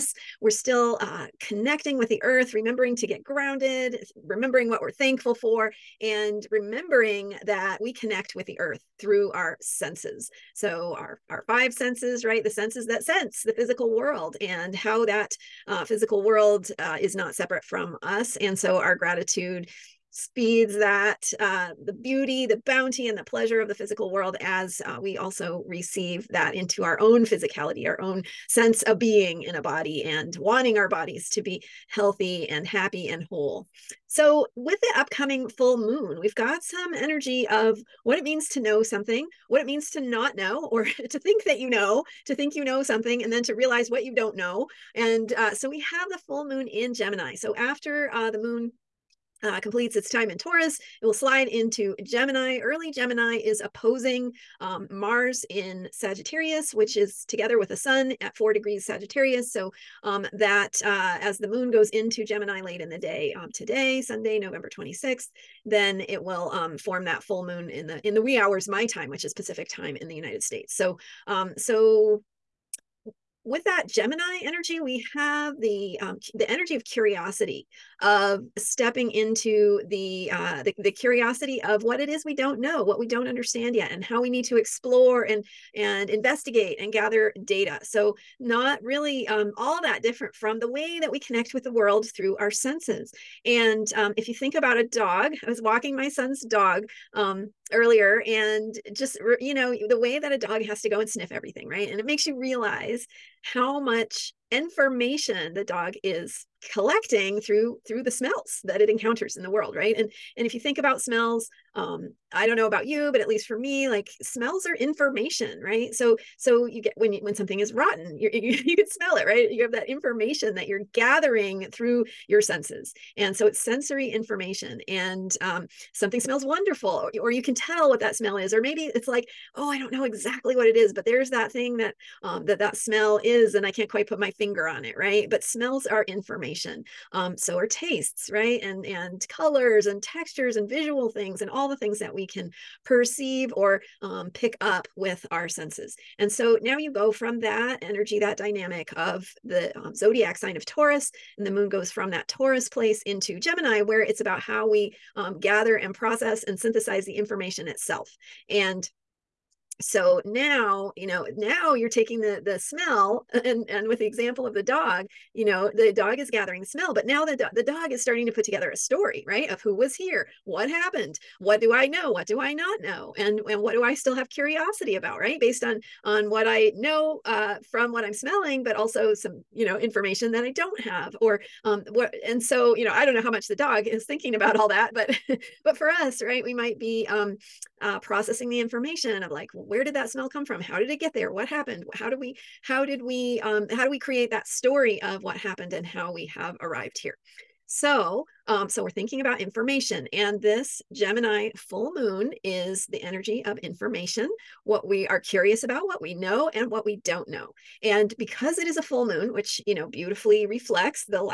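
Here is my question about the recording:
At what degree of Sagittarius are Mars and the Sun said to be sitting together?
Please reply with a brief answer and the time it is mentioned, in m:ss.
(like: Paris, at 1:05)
4 degrees, at 0:58.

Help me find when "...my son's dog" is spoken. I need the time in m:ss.
1:35.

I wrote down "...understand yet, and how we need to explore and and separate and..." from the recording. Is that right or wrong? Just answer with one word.
wrong.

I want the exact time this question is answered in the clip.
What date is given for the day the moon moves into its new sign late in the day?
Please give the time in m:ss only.
1:04.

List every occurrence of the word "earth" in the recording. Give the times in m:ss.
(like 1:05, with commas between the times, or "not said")
0:02, 0:08.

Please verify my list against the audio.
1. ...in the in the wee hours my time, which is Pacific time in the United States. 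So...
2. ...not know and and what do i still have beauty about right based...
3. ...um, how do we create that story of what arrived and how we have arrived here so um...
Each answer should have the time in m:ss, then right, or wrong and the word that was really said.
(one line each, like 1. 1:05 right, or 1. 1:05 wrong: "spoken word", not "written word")
1. 1:07 right
2. 2:52 wrong: "curiosity", not "beauty"
3. 3:13 wrong: "happened", not "arrived".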